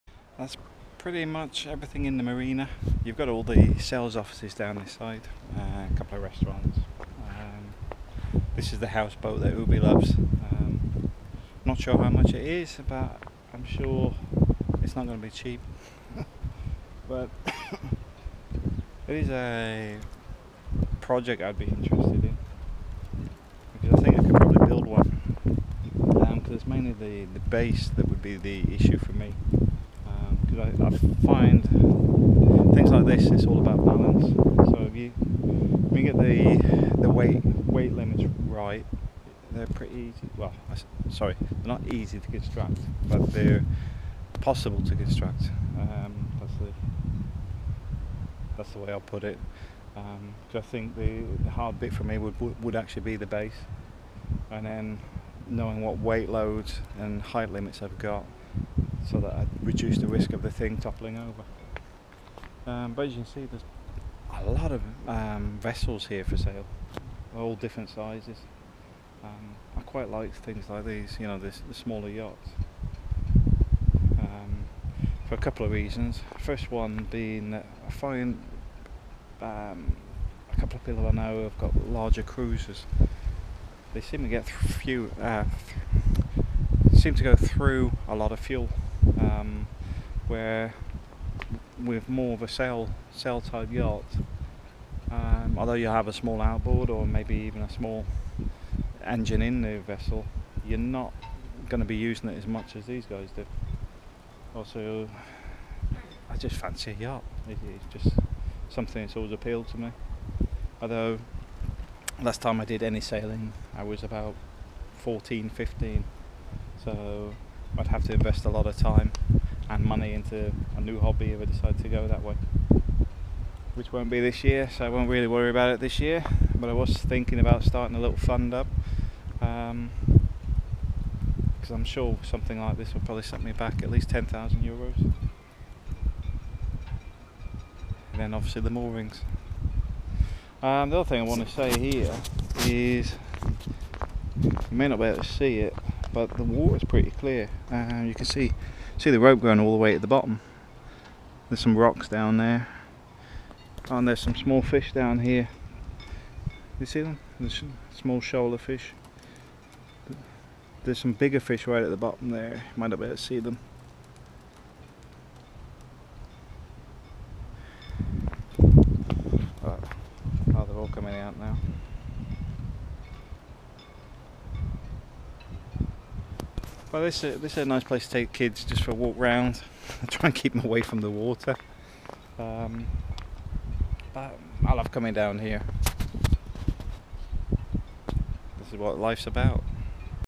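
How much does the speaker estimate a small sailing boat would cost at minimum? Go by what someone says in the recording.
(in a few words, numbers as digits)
10,000 euros.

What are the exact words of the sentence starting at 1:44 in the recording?
Also, I just fancy a yacht.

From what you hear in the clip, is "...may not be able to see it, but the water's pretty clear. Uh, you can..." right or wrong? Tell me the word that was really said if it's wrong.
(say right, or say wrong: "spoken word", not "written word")
right.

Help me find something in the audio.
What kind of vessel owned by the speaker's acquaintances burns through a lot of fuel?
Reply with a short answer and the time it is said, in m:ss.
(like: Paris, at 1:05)
Larger cruisers, at 1:21.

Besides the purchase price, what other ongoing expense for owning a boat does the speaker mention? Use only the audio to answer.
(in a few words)
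The moorings.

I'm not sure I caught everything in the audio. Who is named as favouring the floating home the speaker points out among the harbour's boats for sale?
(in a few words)
Ubi.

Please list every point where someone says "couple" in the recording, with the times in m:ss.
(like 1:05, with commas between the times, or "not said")
0:05, 1:15, 1:20.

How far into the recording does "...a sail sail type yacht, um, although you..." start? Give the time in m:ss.
1:32.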